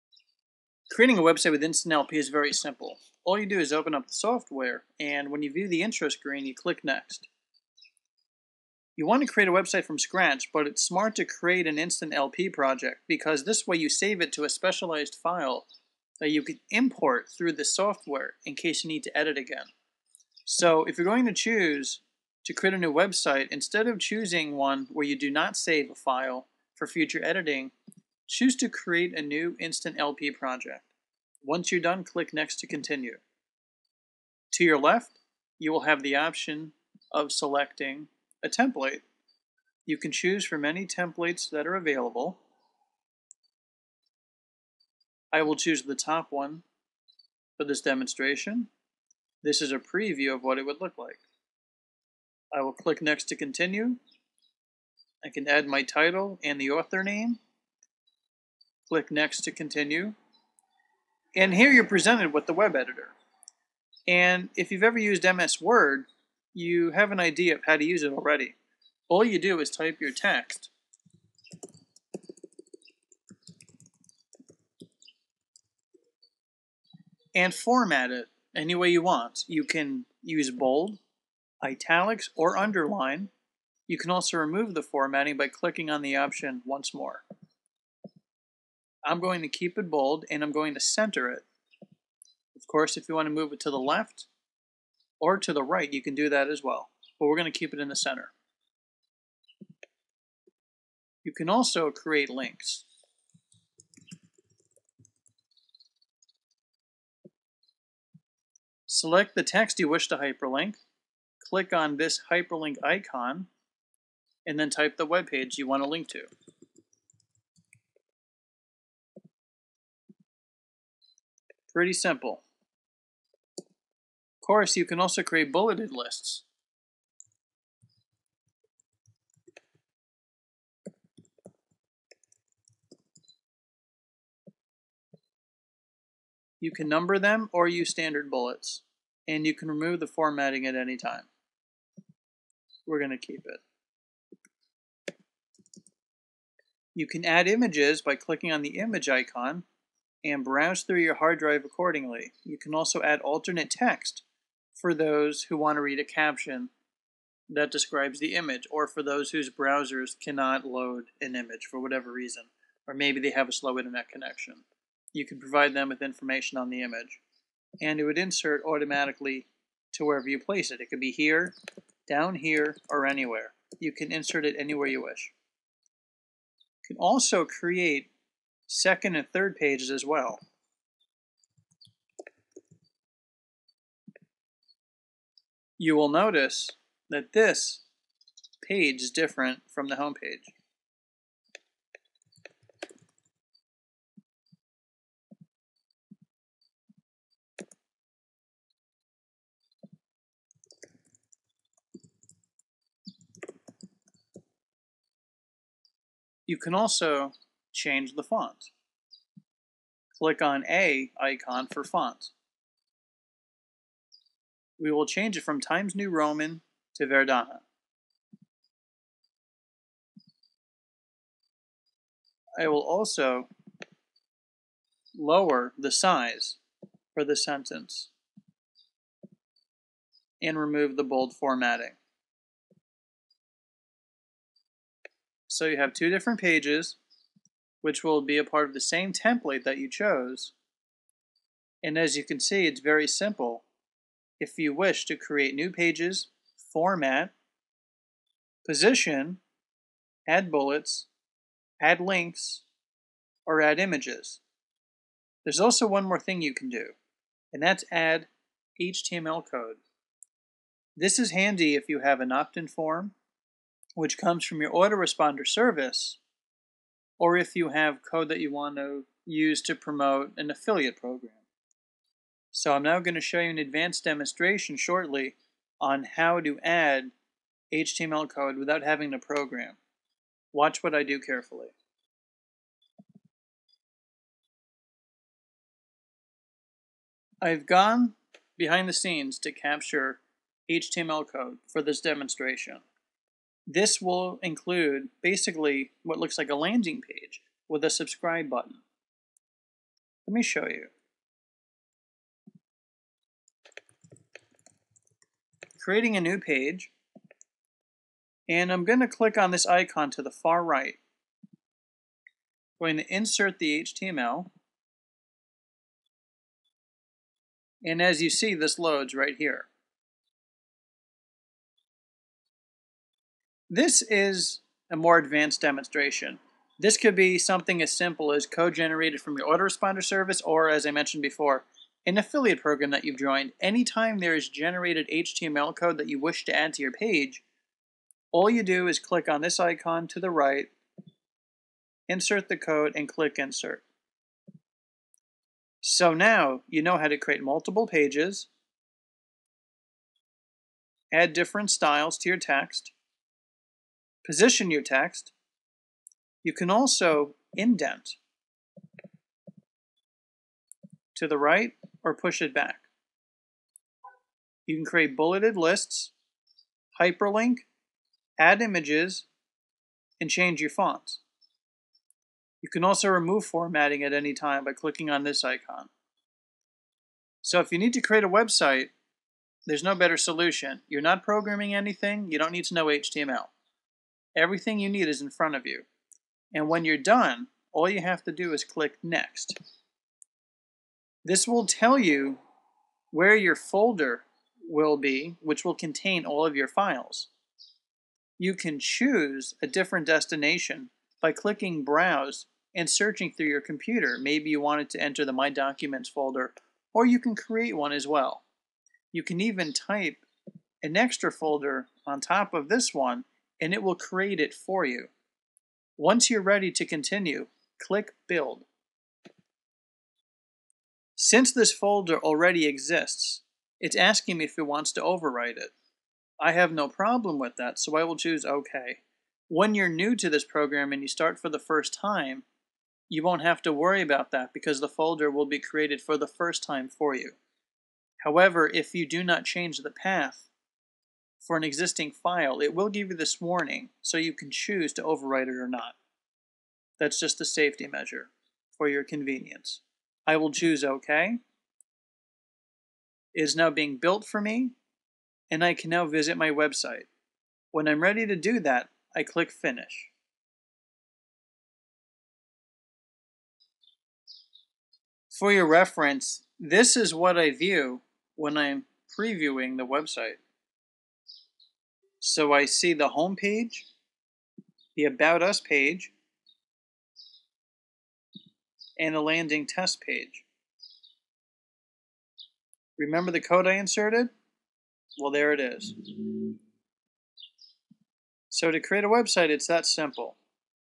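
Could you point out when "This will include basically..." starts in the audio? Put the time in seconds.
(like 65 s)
293 s.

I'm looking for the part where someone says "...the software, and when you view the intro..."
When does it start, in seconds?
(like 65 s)
4 s.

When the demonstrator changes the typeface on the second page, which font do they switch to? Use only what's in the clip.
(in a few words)
Verdana.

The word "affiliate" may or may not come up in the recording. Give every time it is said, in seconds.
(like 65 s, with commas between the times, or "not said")
270 s, 332 s.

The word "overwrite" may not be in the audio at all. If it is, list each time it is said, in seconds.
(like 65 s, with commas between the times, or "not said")
425 s, 445 s.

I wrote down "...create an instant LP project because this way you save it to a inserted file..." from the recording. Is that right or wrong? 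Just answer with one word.
wrong.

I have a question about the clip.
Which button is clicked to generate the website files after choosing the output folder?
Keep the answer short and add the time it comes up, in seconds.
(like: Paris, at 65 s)
Build, at 418 s.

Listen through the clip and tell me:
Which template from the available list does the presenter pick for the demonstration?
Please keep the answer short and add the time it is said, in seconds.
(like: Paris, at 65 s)
The top one, at 45 s.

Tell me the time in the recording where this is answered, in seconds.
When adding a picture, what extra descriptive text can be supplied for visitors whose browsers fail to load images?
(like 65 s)
153 s.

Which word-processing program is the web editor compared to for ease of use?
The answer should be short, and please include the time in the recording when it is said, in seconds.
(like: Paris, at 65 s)
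MS Word, at 65 s.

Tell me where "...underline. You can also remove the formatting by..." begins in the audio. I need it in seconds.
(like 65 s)
82 s.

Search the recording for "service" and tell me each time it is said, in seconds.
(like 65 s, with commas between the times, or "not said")
265 s, 330 s.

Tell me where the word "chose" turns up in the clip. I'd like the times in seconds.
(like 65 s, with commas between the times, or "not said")
239 s.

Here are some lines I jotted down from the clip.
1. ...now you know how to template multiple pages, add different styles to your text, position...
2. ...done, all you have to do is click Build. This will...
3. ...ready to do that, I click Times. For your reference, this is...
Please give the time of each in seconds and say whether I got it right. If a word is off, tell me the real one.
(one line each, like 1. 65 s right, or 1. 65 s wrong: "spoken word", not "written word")
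1. 346 s wrong: "create", not "template"
2. 386 s wrong: "Next", not "Build"
3. 458 s wrong: "Finish", not "Times".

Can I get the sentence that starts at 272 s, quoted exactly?
So I'm now going to show you an advanced demonstration shortly on how to add HTML code without having to program.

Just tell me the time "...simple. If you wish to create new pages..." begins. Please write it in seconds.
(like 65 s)
243 s.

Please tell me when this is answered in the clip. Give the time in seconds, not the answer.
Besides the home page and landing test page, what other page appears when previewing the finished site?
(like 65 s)
475 s.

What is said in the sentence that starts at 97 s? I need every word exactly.
But we're going to keep it in the center.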